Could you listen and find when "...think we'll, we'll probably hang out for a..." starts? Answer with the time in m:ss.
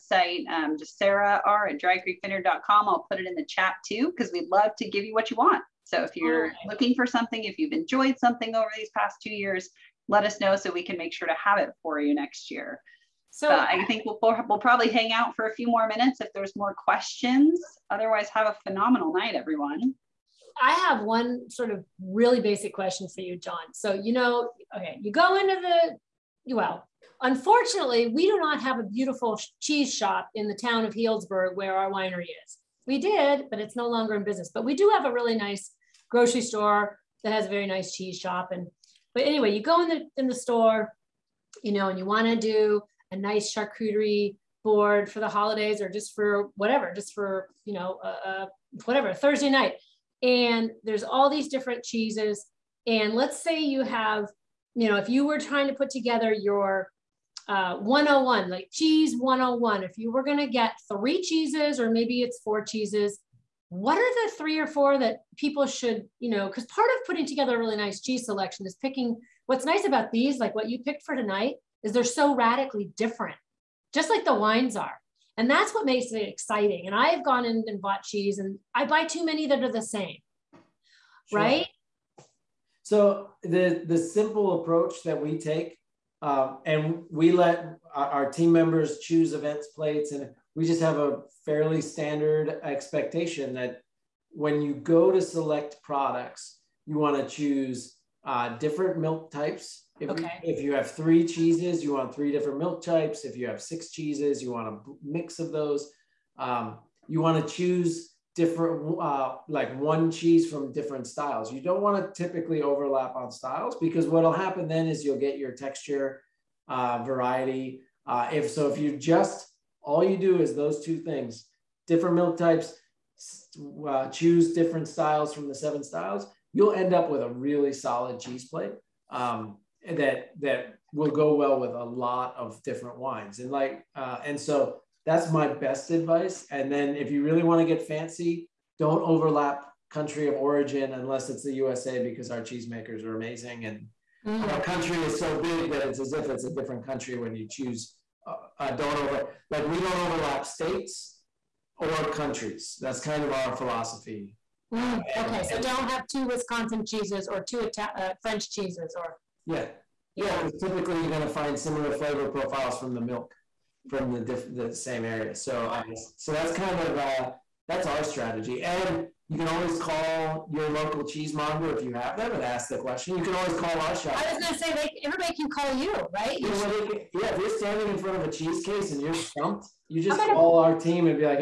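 0:13.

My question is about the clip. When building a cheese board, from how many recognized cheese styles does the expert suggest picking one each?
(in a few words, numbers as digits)
7.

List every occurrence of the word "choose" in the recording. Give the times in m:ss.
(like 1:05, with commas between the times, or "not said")
1:28, 1:37, 1:47, 2:04, 2:27.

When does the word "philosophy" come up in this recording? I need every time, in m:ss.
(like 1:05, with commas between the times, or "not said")
2:33.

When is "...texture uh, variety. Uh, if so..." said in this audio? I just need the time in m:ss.
1:55.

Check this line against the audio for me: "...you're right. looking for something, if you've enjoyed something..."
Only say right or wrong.
right.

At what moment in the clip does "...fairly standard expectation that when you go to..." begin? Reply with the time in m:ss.
1:31.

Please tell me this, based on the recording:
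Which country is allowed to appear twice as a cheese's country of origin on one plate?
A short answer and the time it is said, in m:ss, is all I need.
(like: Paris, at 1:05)
USA, at 2:21.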